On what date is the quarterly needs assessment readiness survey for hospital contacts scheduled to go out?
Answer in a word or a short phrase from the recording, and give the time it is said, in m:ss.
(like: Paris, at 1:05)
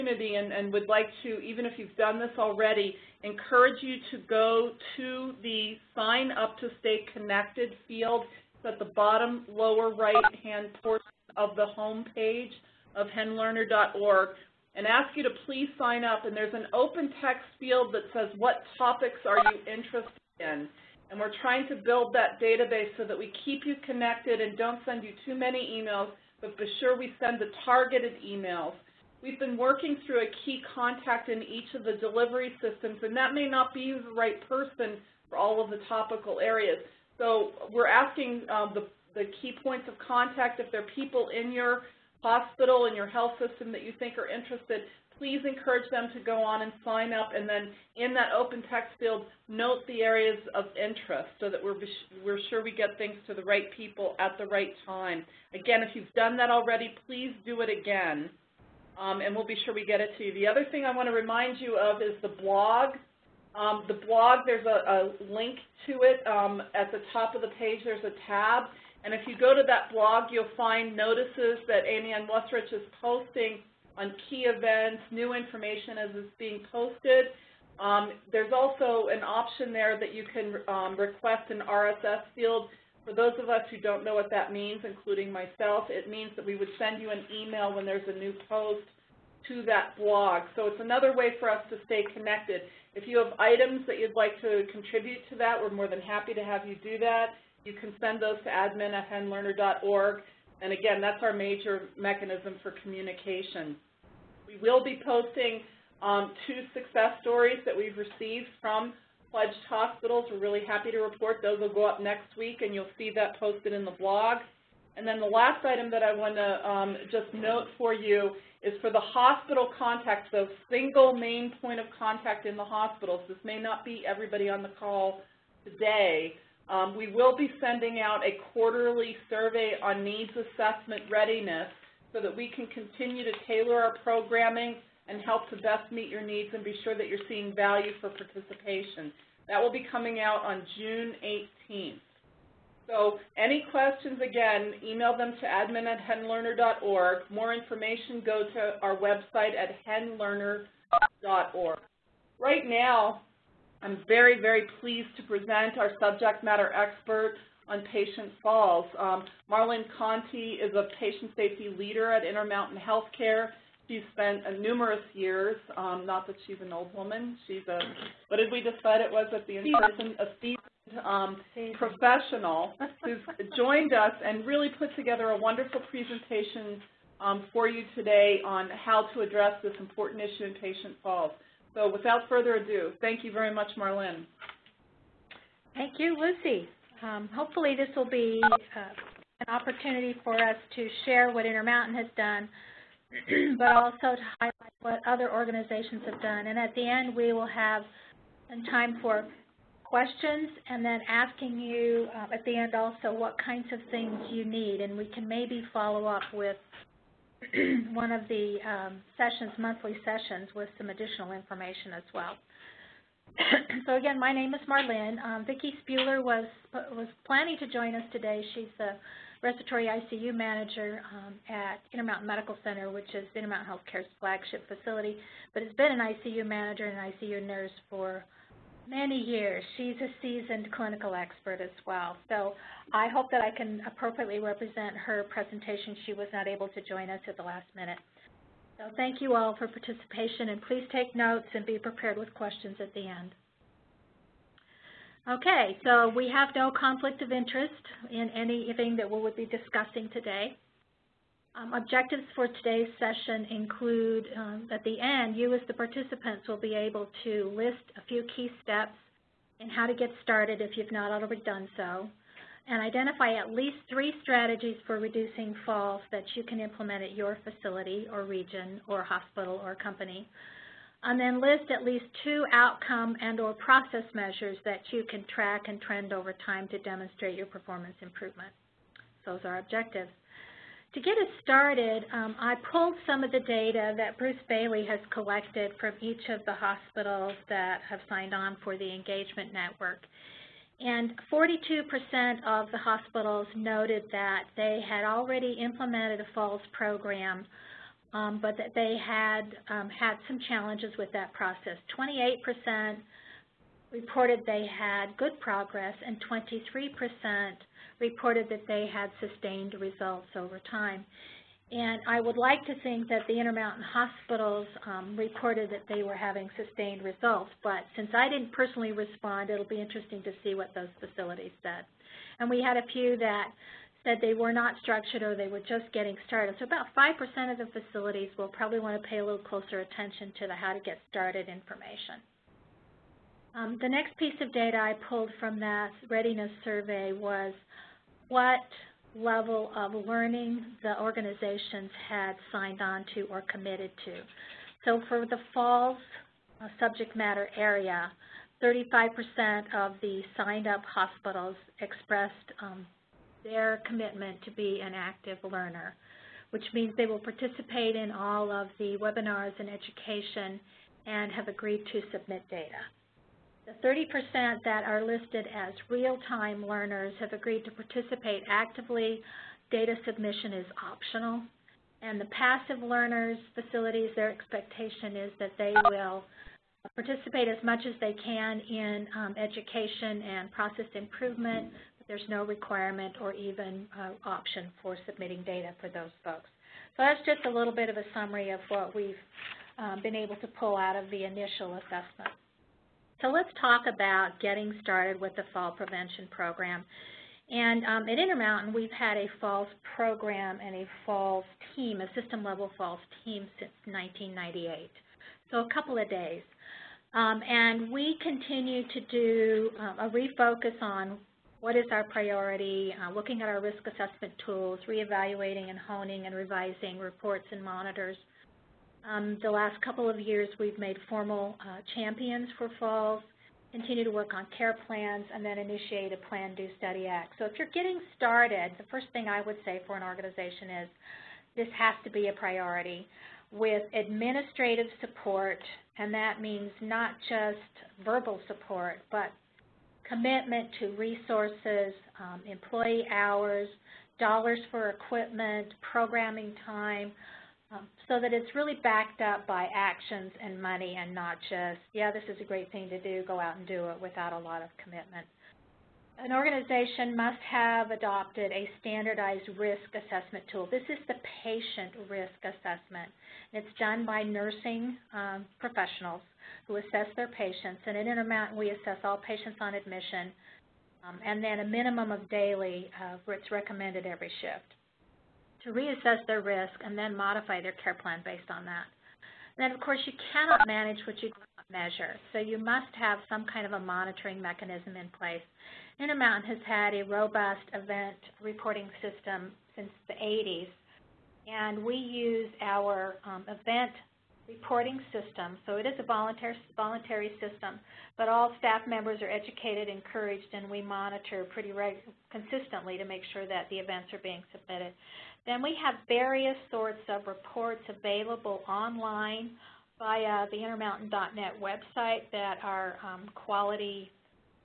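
June 18th, at 2:20.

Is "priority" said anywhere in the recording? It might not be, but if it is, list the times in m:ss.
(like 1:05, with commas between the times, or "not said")
6:52, 7:12.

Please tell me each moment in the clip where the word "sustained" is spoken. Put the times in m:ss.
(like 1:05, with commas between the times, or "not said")
5:09, 5:16.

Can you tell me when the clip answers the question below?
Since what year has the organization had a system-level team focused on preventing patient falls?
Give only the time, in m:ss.
6:43.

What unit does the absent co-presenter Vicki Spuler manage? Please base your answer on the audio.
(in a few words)
respiratory ICU.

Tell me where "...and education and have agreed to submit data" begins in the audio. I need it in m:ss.
5:59.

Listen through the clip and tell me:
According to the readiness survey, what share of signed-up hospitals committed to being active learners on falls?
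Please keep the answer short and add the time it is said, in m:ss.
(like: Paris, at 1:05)
35%, at 5:48.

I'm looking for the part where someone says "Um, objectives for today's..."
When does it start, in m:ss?
4:11.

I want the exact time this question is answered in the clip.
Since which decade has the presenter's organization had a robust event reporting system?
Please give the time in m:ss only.
8:10.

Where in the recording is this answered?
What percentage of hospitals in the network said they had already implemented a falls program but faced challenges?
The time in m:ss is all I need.
4:51.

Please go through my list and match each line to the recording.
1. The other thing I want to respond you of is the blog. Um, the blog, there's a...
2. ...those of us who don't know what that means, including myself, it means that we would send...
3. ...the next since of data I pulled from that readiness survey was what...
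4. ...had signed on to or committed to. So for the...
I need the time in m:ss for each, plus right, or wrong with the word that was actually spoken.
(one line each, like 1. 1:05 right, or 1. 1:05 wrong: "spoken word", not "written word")
1. 1:00 wrong: "remind", not "respond"
2. 1:23 right
3. 5:33 wrong: "piece", not "since"
4. 5:42 right.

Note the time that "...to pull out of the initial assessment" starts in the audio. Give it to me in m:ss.
6:30.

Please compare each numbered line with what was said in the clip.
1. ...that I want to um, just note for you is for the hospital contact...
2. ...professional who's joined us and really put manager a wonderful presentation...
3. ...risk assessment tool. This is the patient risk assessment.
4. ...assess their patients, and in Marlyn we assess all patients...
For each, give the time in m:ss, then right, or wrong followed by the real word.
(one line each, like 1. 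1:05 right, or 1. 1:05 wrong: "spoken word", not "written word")
1. 1:55 right
2. 2:51 wrong: "together", not "manager"
3. 7:39 right
4. 7:46 wrong: "Intermountain", not "Marlyn".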